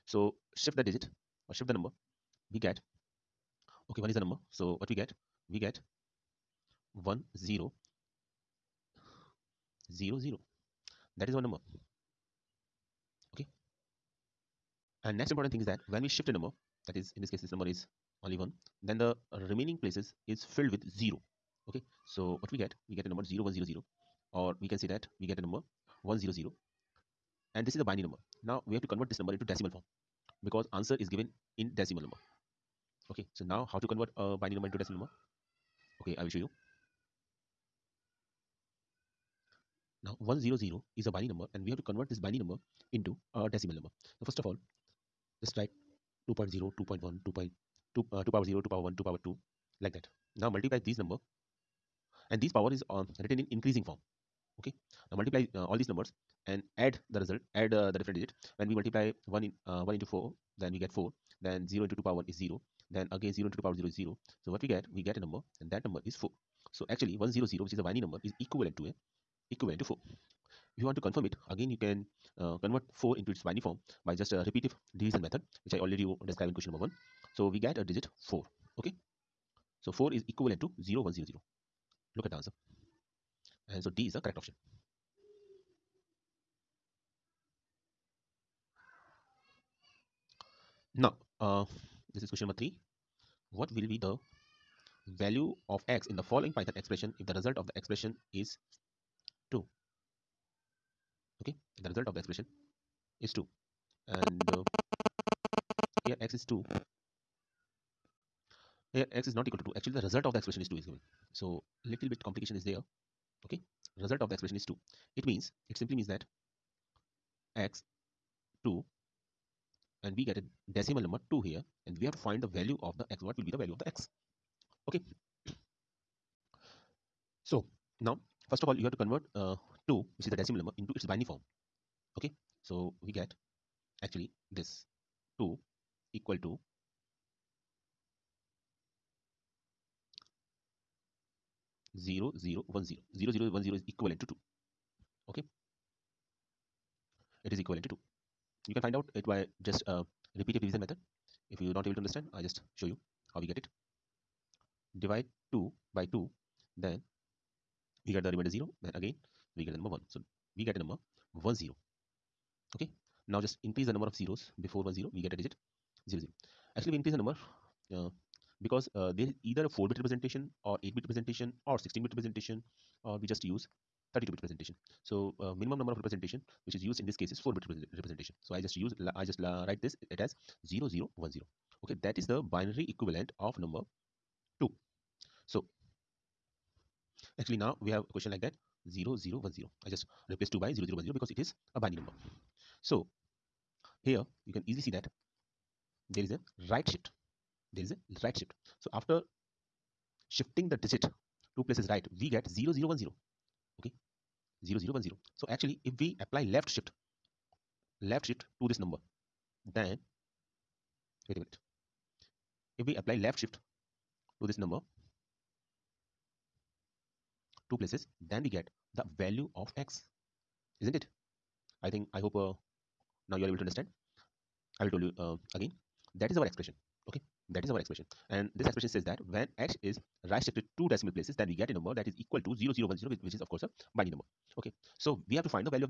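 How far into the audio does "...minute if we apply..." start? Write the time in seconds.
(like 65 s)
211 s.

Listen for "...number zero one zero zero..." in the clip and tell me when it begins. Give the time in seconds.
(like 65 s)
23 s.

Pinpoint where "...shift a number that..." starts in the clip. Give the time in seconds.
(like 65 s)
16 s.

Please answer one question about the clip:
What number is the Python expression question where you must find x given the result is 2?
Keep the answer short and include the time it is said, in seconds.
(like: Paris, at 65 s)
three, at 92 s.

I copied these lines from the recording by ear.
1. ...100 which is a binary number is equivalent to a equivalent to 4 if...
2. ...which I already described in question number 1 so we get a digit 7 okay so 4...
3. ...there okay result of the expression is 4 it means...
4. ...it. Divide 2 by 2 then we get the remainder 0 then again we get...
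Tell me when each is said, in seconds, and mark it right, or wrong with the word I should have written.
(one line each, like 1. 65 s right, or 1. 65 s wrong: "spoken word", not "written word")
1. 67 s right
2. 75 s wrong: "4", not "7"
3. 112 s wrong: "2", not "4"
4. 153 s right.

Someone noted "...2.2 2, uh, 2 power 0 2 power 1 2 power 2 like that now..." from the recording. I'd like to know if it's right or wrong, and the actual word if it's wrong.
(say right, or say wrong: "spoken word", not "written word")
right.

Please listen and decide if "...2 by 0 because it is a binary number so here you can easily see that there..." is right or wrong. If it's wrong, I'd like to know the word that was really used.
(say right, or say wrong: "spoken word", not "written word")
wrong: "0", not "2".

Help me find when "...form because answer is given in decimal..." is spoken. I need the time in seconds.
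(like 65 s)
29 s.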